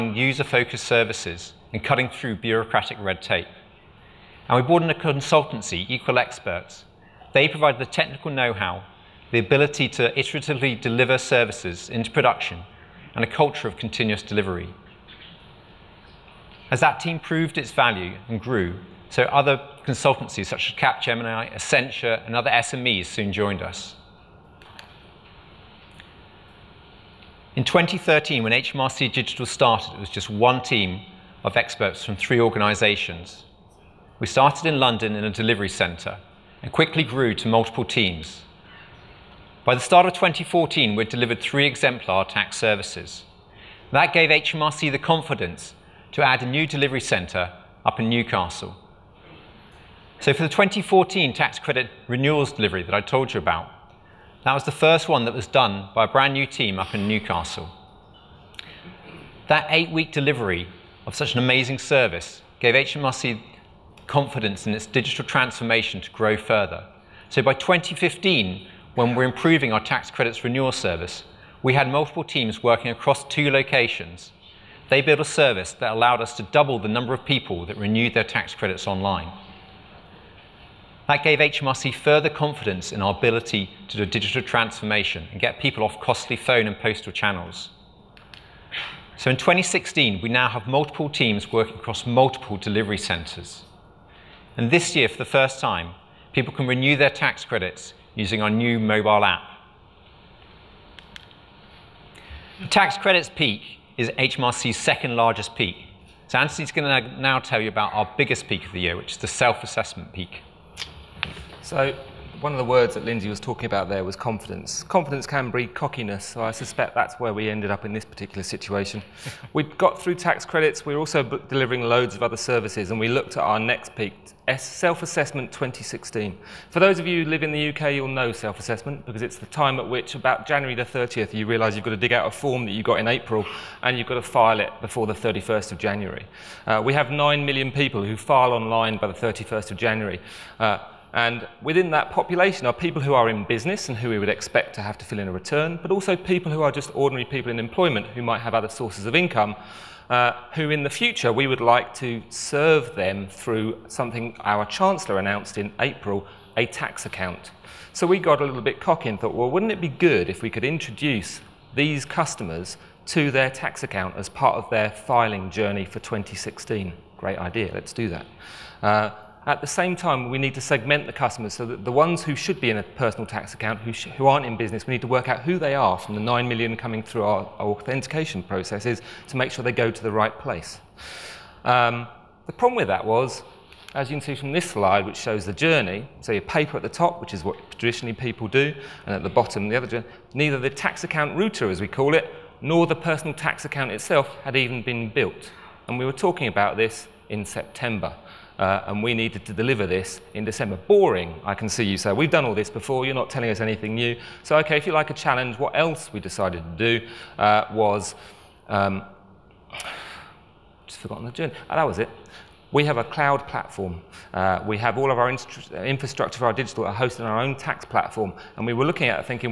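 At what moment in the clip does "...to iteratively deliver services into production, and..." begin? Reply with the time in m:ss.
0:09.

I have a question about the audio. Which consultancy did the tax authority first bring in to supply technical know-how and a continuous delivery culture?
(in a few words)
Equal Experts.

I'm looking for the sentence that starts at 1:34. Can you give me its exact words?
And this year, for the first time, people can renew their tax credits using our new mobile app.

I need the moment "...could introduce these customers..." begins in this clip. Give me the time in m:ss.
2:40.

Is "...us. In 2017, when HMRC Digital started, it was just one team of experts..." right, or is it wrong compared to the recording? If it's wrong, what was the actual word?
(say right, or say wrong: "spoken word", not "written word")
wrong: "2013", not "2017".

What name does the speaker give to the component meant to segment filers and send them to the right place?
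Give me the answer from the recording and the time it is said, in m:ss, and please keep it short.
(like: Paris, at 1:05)
tax account router, at 3:10.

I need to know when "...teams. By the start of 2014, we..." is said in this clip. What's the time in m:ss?
0:37.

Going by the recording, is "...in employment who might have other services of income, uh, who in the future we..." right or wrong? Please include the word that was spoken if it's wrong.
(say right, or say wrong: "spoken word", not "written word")
wrong: "sources", not "services".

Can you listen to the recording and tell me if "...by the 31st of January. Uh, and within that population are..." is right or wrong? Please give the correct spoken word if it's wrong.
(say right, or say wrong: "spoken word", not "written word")
right.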